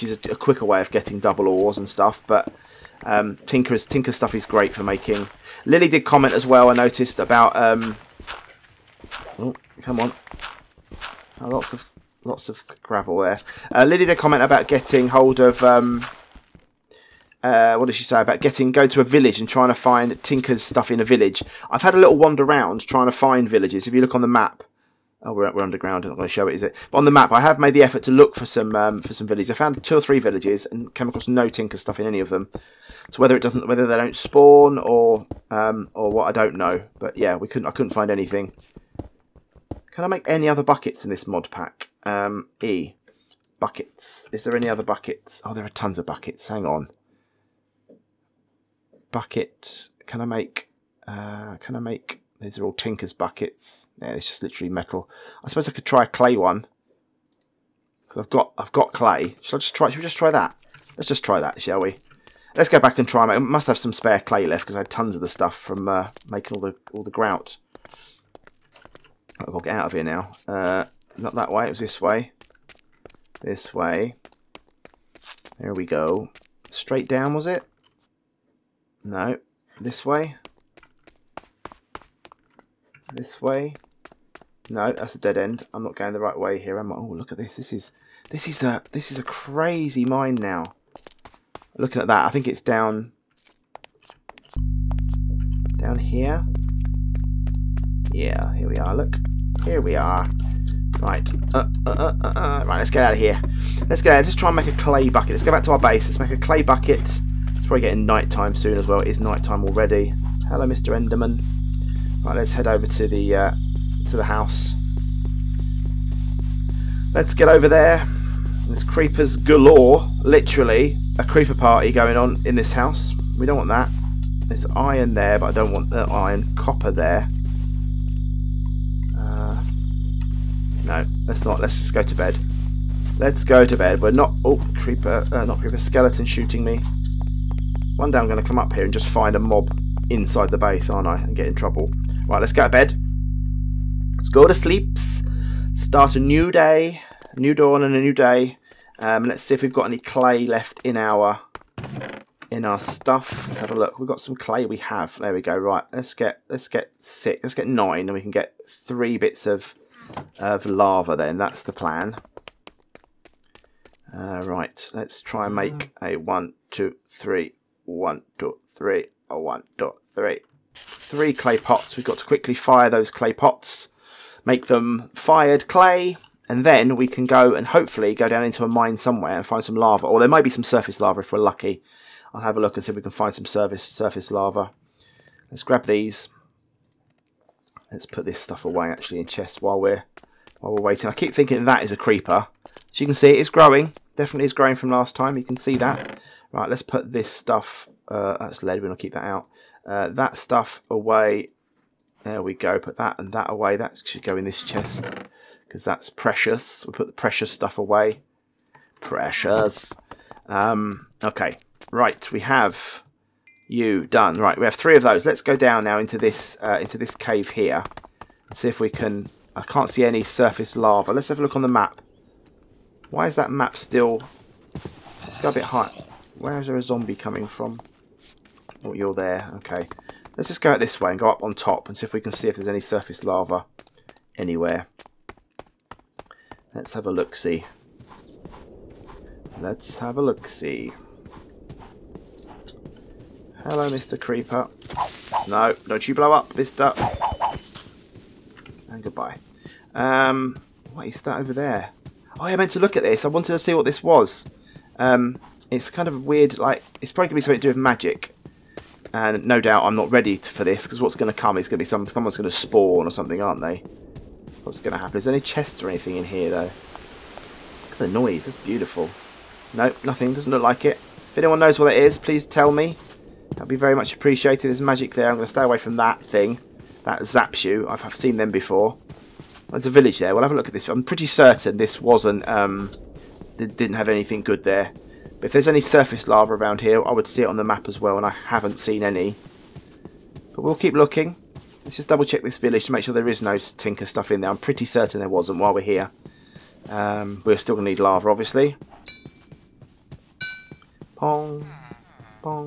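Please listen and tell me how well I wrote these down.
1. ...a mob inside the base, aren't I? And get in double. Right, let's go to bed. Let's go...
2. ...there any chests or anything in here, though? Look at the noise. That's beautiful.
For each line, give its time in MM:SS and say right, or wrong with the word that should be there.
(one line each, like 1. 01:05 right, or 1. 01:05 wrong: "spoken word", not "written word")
1. 02:19 wrong: "trouble", not "double"
2. 04:25 right.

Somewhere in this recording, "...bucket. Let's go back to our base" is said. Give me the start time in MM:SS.
01:45.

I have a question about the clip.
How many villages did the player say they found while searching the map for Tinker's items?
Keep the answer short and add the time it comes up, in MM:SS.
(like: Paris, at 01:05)
2 or 3, at 00:29.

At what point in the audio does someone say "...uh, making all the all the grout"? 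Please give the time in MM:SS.
01:05.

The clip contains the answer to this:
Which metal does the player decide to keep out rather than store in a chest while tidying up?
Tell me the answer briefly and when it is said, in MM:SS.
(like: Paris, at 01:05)
Lead, at 03:18.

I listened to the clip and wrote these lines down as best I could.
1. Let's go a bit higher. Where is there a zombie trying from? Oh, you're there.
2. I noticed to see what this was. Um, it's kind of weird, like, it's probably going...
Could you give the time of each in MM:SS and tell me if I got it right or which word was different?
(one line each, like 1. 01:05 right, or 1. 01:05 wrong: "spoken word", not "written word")
1. 03:45 wrong: "coming", not "trying"
2. 04:13 wrong: "wanted", not "noticed".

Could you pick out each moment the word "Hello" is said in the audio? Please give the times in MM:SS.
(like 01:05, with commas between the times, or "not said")
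01:50, 04:03.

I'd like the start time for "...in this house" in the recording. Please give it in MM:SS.
02:02.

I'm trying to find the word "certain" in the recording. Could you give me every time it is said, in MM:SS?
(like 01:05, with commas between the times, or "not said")
04:41, 04:54.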